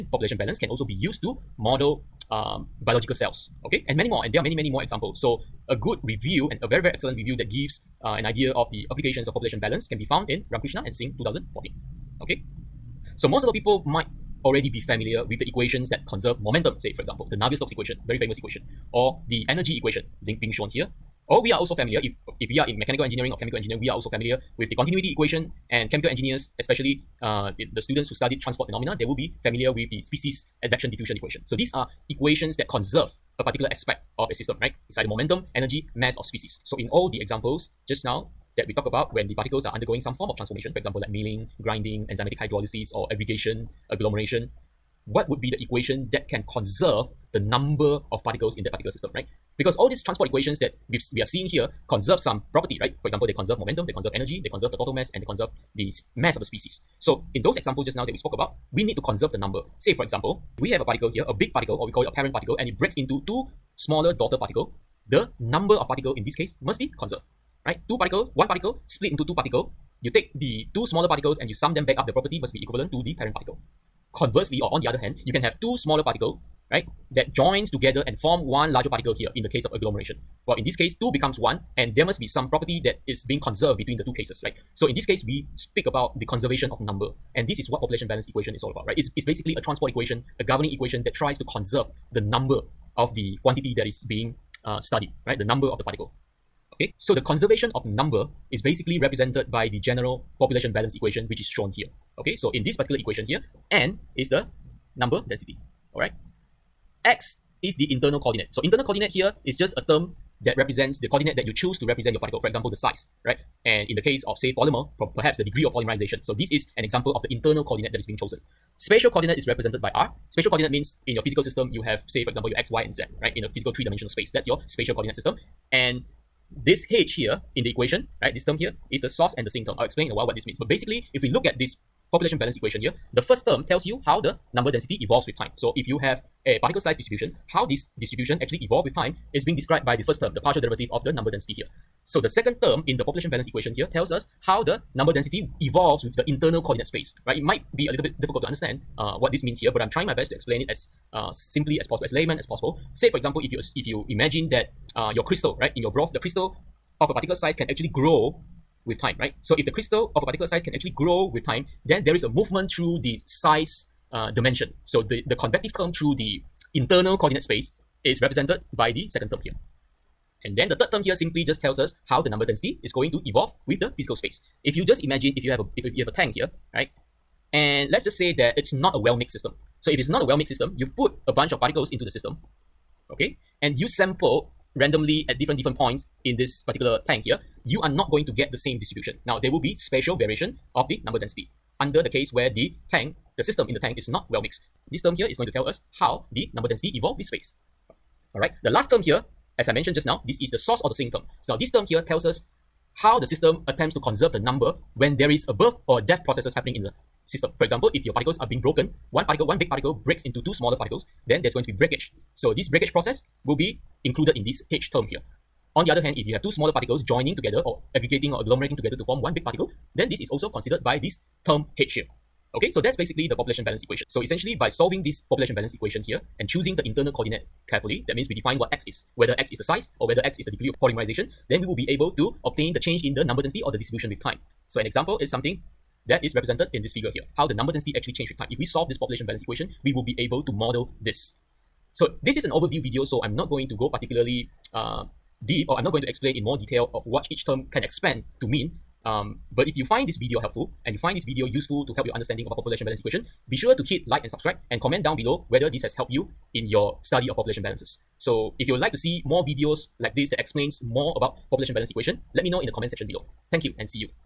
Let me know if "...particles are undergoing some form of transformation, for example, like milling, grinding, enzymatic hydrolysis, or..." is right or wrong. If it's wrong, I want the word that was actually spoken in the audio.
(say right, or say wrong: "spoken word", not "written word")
right.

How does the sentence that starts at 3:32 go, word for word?
So this breakage process will be included in this H term here.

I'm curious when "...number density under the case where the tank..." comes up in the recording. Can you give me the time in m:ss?
3:11.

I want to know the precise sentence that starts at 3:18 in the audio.
All right, the last term here, as I mentioned just now, this is the source or the sink term.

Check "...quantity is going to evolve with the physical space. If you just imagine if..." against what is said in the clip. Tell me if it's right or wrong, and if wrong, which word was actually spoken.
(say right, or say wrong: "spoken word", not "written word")
wrong: "density", not "quantity".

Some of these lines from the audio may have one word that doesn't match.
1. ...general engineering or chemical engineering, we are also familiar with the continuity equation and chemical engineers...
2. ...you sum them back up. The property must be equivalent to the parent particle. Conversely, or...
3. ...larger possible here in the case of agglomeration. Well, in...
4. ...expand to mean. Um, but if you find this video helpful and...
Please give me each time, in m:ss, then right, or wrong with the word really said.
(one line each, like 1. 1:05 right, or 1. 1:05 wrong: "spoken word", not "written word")
1. 0:22 wrong: "mechanical", not "general"
2. 1:11 right
3. 1:18 wrong: "particle", not "possible"
4. 4:07 right.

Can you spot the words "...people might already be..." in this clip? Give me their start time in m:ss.
0:13.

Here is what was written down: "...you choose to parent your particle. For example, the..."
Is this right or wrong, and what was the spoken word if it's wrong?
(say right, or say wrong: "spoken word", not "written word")
wrong: "represent", not "parent".